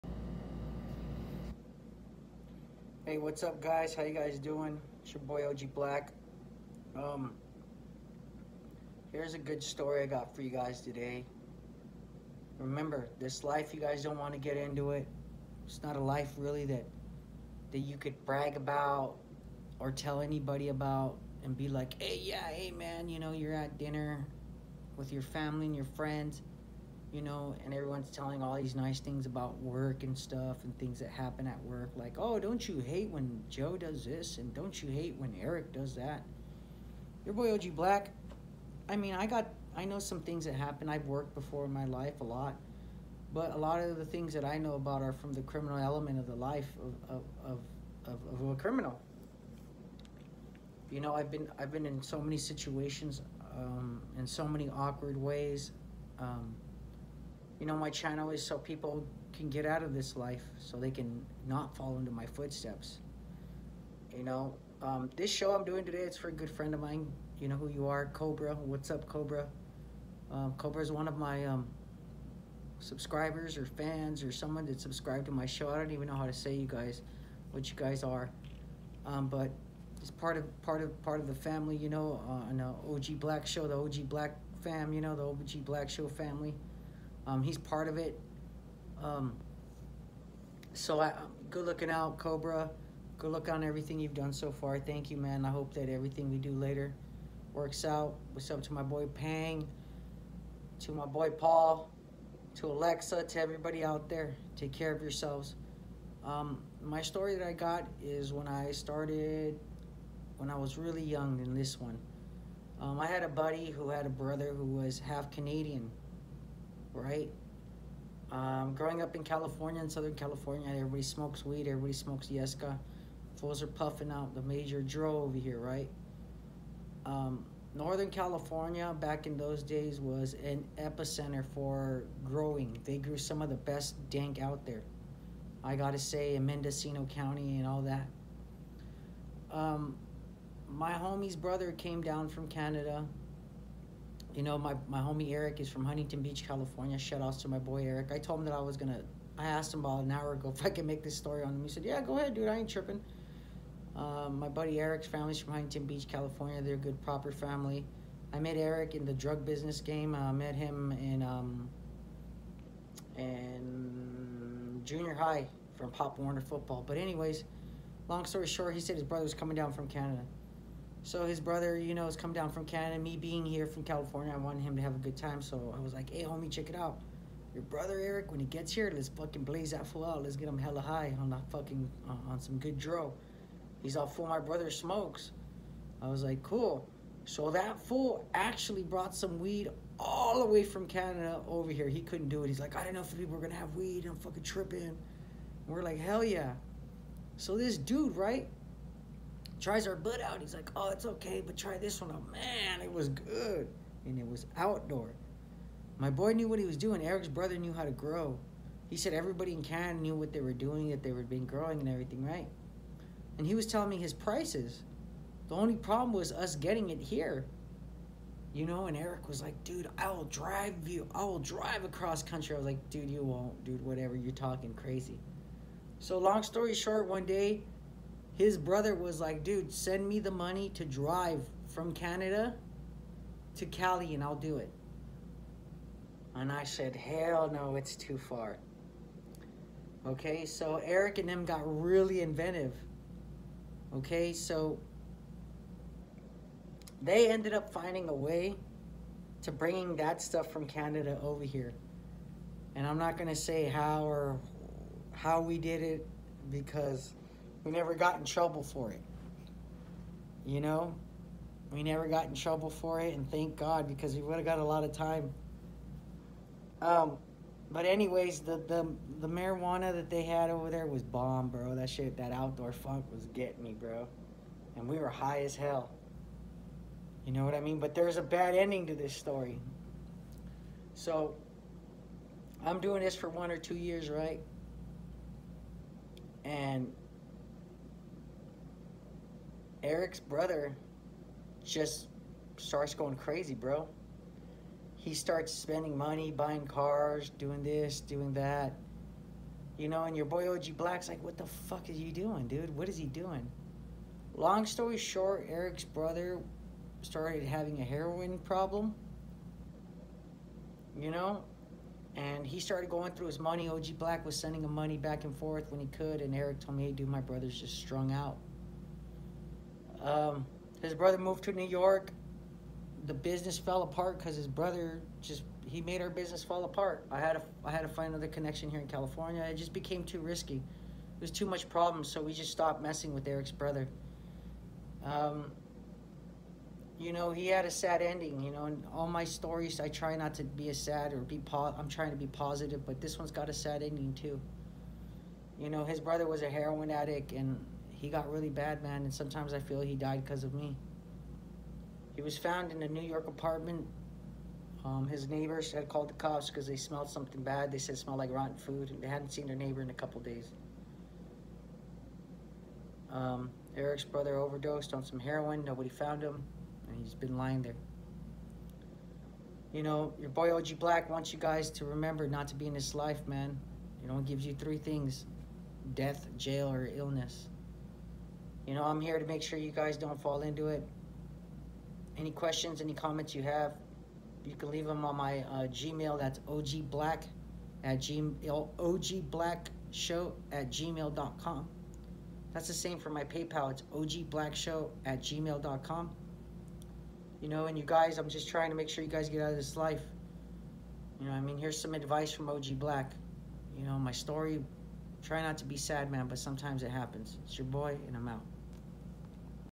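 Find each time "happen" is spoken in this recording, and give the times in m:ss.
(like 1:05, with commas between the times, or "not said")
0:31, 0:40, 6:46.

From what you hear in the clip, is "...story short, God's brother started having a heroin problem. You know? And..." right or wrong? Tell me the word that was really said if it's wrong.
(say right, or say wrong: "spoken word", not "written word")
wrong: "Eric", not "God".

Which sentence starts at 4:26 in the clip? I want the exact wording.
Um, but anyways, the, the the marijuana that they had over there was bomb, bro.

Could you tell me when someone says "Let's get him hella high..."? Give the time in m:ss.
3:00.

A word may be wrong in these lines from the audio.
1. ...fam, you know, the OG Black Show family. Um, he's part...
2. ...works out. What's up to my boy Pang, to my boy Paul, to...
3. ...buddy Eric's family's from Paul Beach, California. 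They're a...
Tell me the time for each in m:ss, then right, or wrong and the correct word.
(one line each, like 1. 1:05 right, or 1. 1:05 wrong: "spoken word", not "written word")
1. 1:24 right
2. 1:37 right
3. 2:34 wrong: "Huntington", not "Paul".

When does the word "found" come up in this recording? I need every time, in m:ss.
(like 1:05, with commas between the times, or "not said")
5:52, 6:05.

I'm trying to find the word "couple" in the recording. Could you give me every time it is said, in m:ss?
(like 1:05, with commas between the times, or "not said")
5:59.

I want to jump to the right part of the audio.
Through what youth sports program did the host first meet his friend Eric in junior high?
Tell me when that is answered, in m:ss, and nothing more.
2:45.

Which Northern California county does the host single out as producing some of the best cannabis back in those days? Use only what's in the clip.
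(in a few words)
Mendocino County.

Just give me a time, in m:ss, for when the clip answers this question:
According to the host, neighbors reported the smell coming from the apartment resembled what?
5:58.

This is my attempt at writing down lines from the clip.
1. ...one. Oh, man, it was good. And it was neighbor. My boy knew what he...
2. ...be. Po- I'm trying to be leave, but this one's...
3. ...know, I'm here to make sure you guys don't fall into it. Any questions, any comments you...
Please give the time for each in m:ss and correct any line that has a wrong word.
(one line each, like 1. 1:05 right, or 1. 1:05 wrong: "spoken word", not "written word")
1. 3:22 wrong: "outdoor", not "neighbor"
2. 5:41 wrong: "positive", not "leave"
3. 6:18 right.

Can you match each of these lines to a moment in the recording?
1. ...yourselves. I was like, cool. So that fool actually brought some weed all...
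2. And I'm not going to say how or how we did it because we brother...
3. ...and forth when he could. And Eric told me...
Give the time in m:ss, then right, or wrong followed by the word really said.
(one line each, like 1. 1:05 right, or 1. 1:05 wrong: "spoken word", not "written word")
1. 3:04 wrong: "smokes", not "yourselves"
2. 4:12 wrong: "never", not "brother"
3. 5:15 right.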